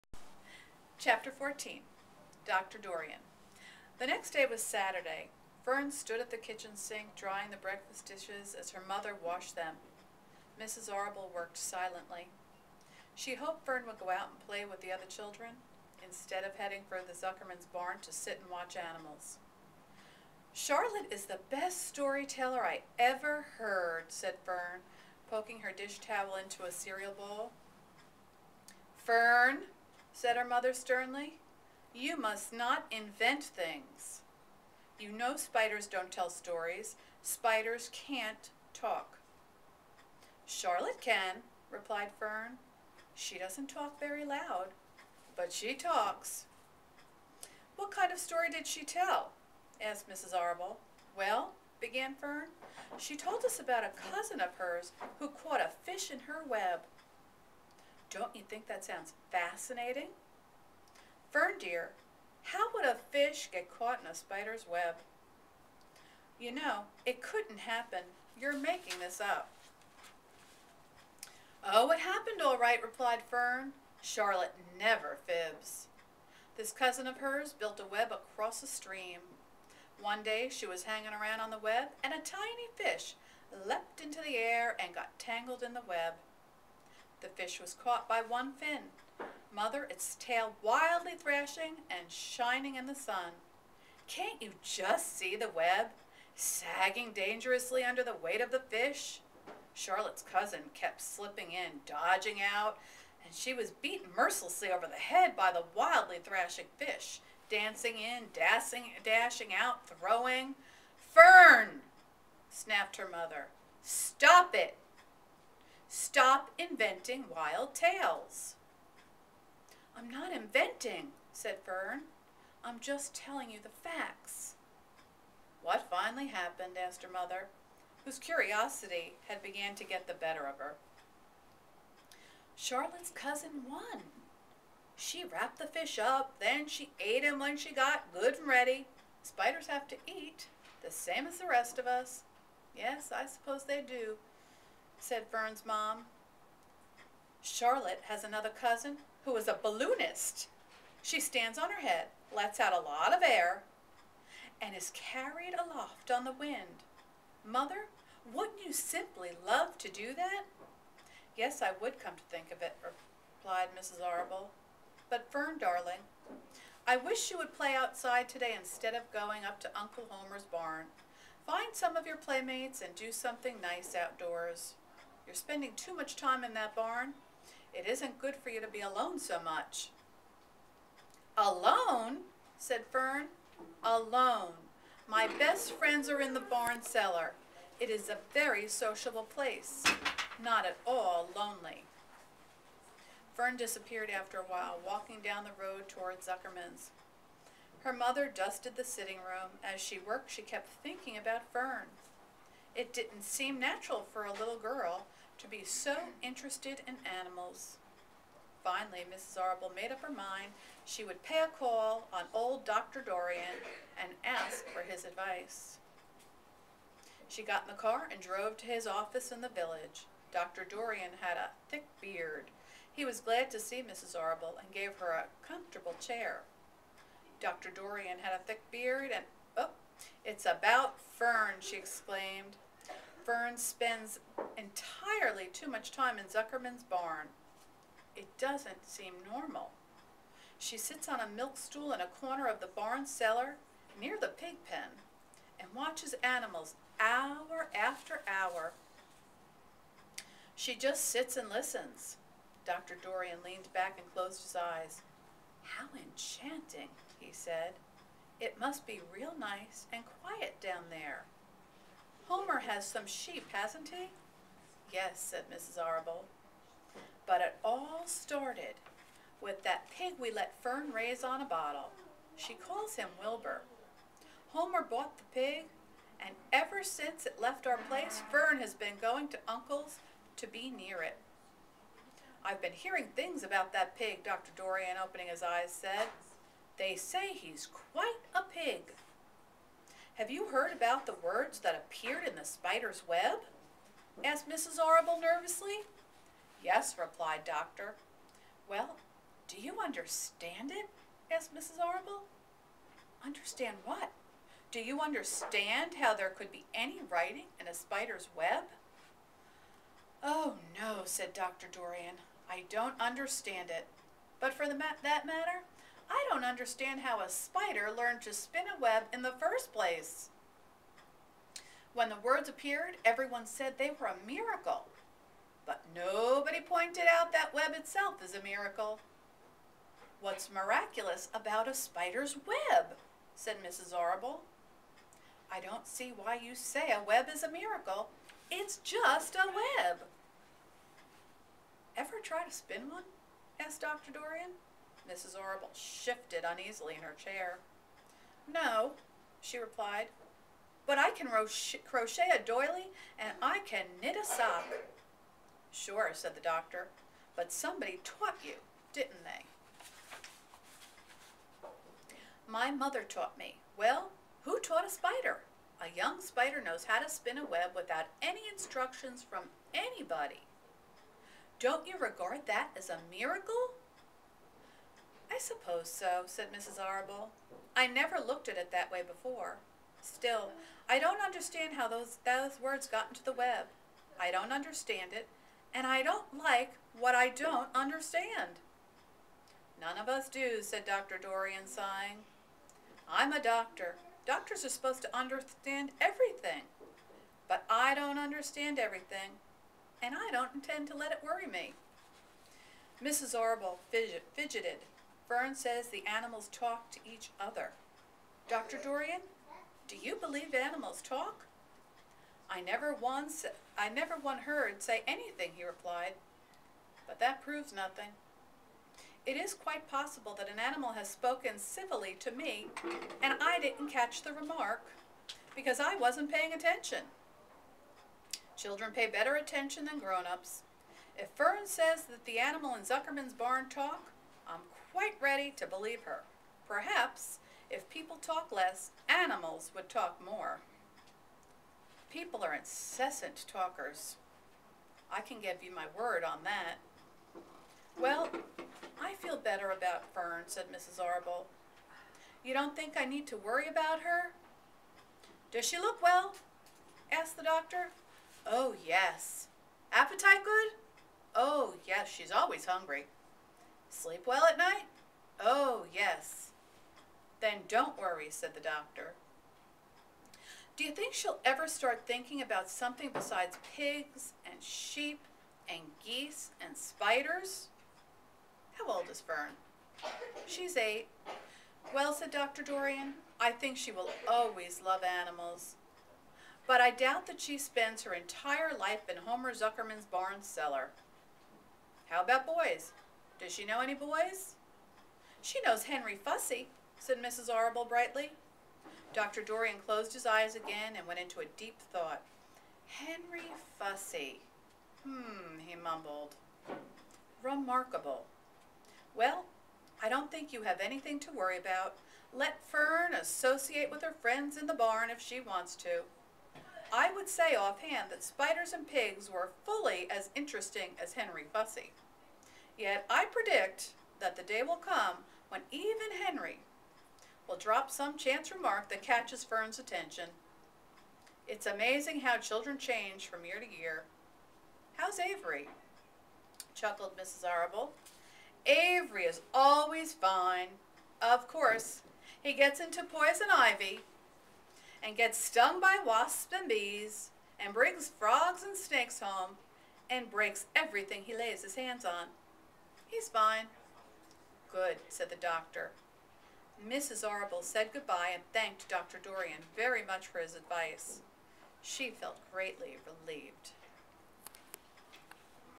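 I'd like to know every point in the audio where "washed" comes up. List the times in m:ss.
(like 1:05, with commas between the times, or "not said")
0:09.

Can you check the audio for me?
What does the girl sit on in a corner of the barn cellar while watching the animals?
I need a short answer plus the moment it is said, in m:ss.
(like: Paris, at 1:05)
A milk stool, at 4:01.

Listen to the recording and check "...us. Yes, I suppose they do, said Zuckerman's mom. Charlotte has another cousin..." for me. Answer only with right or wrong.
wrong.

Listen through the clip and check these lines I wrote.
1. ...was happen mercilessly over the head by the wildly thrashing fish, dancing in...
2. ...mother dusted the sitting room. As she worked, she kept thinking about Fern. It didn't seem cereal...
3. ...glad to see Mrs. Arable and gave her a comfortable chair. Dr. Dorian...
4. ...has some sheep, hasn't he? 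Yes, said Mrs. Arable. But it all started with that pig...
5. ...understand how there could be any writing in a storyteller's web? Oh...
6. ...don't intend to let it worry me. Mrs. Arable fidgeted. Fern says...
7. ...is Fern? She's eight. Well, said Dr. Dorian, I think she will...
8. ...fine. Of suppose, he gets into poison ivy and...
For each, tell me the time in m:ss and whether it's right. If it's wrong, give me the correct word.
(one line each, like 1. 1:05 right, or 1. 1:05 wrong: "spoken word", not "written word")
1. 1:43 wrong: "beaten", not "happen"
2. 3:17 wrong: "natural", not "cereal"
3. 3:43 right
4. 4:22 right
5. 5:05 wrong: "spider", not "storyteller"
6. 6:40 right
7. 7:59 right
8. 9:00 wrong: "course", not "suppose".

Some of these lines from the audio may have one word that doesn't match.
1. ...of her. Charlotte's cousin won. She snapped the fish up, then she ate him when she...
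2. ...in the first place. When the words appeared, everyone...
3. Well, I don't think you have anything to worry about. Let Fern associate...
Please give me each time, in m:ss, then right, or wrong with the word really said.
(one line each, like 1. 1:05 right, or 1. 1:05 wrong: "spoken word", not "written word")
1. 2:10 wrong: "wrapped", not "snapped"
2. 5:19 right
3. 8:29 right.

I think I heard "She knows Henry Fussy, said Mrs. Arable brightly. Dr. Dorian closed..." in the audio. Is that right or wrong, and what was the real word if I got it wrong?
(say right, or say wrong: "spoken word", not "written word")
right.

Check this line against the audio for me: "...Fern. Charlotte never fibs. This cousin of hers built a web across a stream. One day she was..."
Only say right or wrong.
right.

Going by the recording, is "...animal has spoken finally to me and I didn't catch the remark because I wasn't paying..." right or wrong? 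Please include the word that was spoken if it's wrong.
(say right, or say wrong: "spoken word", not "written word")
wrong: "civilly", not "finally".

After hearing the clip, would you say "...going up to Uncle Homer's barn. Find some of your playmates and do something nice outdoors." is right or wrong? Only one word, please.
right.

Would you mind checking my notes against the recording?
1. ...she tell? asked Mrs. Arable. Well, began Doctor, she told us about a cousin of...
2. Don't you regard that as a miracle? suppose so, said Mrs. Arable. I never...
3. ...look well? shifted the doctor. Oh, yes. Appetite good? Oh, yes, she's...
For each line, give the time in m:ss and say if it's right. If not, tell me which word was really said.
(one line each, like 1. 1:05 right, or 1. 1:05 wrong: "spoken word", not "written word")
1. 0:48 wrong: "Fern", not "Doctor"
2. 6:11 right
3. 7:35 wrong: "asked", not "shifted".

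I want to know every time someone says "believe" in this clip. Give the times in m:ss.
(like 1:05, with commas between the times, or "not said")
6:50, 7:15.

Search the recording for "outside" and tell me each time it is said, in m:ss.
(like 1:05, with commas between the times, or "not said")
2:47.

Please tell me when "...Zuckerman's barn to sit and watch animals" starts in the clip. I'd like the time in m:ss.
0:17.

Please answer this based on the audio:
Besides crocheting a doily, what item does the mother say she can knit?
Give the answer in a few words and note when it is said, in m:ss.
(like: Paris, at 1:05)
A sock, at 5:54.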